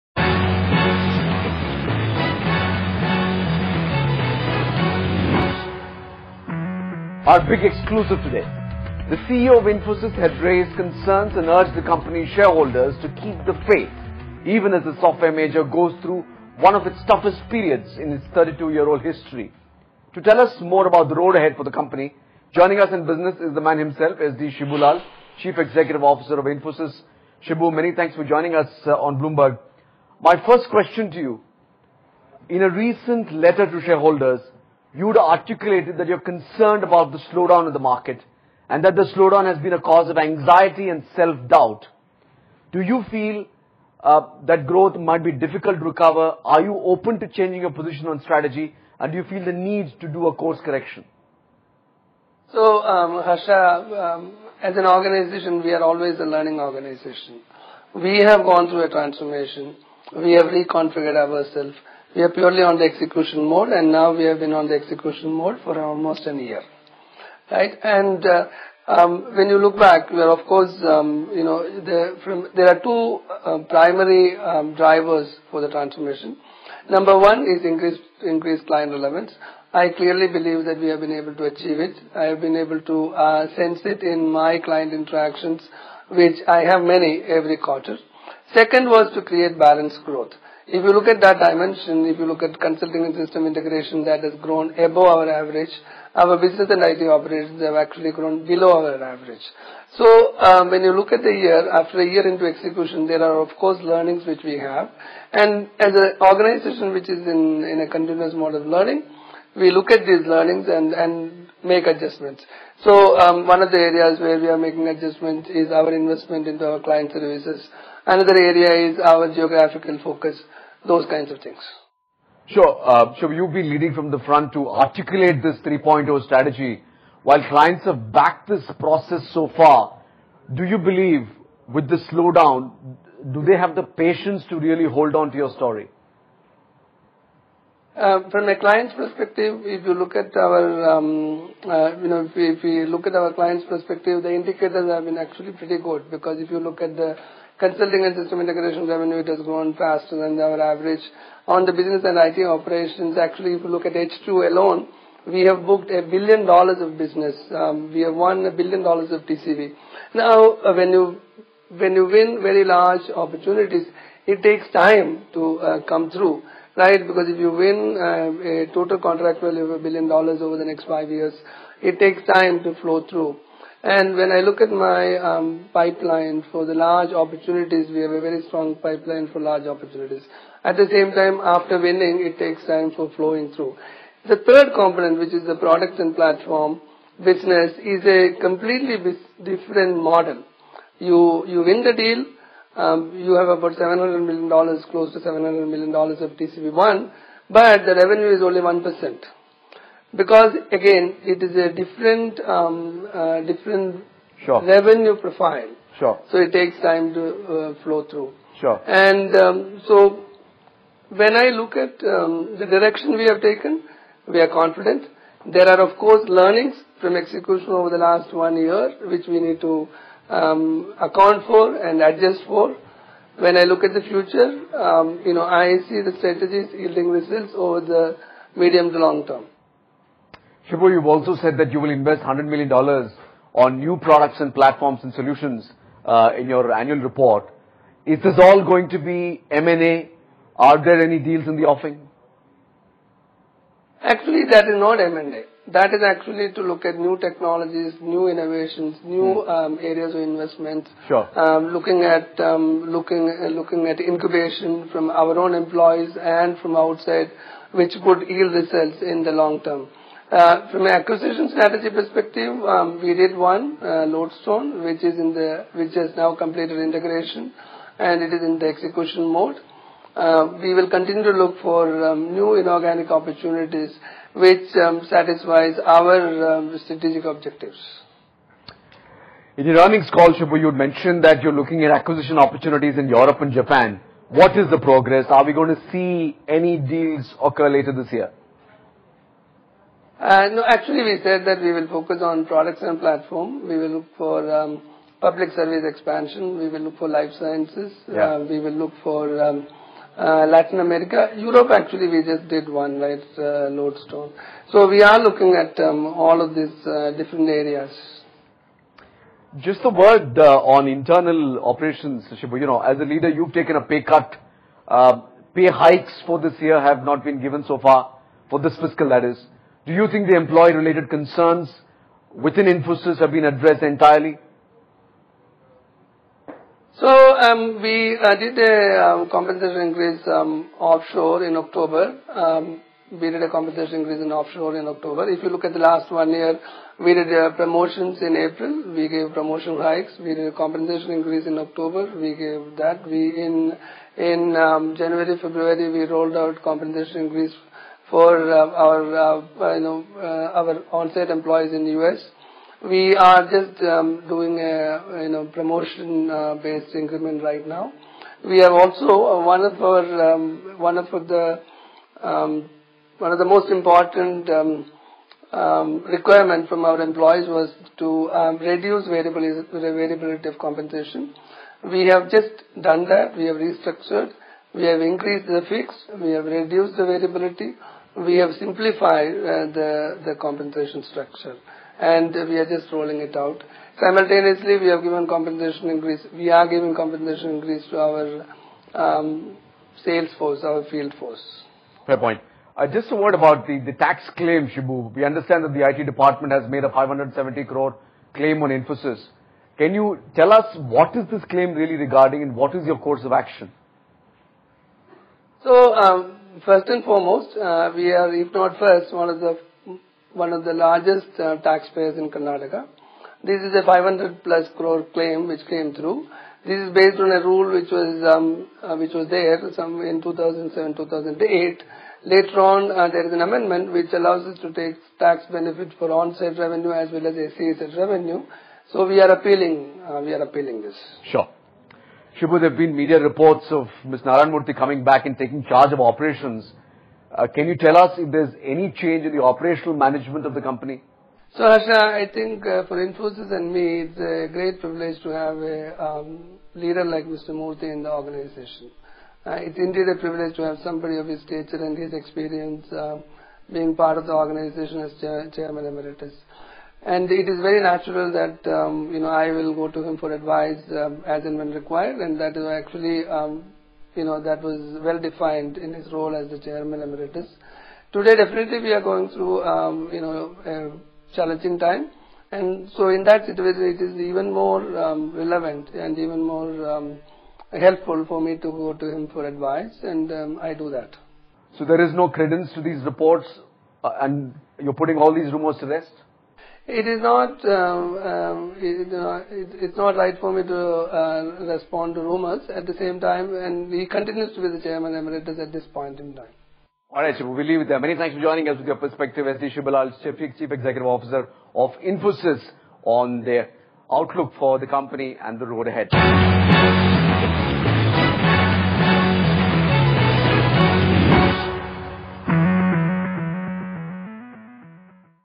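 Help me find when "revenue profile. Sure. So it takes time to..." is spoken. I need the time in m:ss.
3:24.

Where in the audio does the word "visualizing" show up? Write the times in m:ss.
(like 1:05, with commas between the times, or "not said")
not said.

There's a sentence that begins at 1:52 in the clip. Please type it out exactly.
So um, one of the areas where we are making adjustments is our investment into our client services.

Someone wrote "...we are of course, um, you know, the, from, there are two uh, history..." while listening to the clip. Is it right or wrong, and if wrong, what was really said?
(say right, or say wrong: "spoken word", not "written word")
wrong: "primary", not "history".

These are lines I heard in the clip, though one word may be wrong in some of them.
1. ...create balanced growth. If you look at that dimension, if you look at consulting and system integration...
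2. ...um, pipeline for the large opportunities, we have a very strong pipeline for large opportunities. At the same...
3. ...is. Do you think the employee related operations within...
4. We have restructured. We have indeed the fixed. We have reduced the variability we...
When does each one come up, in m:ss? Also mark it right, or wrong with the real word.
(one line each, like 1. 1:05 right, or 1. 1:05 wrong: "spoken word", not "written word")
1. 1:29 right
2. 2:55 right
3. 5:19 wrong: "concerns", not "operations"
4. 6:13 wrong: "increased", not "indeed".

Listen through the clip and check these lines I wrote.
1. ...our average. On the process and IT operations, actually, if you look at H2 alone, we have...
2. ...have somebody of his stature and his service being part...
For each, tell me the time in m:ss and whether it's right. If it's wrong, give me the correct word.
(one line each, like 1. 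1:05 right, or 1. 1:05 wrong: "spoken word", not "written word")
1. 2:30 wrong: "business", not "process"
2. 7:30 wrong: "experience", not "service".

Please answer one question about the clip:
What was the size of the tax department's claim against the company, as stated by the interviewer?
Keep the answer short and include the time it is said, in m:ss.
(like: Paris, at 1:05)
570 crore, at 6:36.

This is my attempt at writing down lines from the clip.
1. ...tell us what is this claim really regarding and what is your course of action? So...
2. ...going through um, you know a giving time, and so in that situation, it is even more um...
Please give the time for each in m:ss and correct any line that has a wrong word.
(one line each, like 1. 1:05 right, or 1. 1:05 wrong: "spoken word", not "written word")
1. 6:40 right
2. 7:49 wrong: "challenging", not "giving".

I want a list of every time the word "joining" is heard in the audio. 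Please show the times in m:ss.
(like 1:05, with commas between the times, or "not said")
0:22, 0:28, 8:18.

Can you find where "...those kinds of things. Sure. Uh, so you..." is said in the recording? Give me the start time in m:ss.
2:00.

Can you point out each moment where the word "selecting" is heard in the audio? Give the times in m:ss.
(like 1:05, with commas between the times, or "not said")
not said.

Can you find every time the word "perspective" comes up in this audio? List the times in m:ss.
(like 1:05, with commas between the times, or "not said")
2:18, 2:23, 4:21, 8:18.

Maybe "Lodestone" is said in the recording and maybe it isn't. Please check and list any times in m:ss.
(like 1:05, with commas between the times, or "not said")
4:24, 5:03.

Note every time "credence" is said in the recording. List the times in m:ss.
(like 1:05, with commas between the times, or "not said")
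8:02.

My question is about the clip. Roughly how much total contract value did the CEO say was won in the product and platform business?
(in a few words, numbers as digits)
$700 million.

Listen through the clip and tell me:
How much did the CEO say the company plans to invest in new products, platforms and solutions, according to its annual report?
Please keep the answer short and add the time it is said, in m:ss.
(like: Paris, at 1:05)
$100 million, at 3:52.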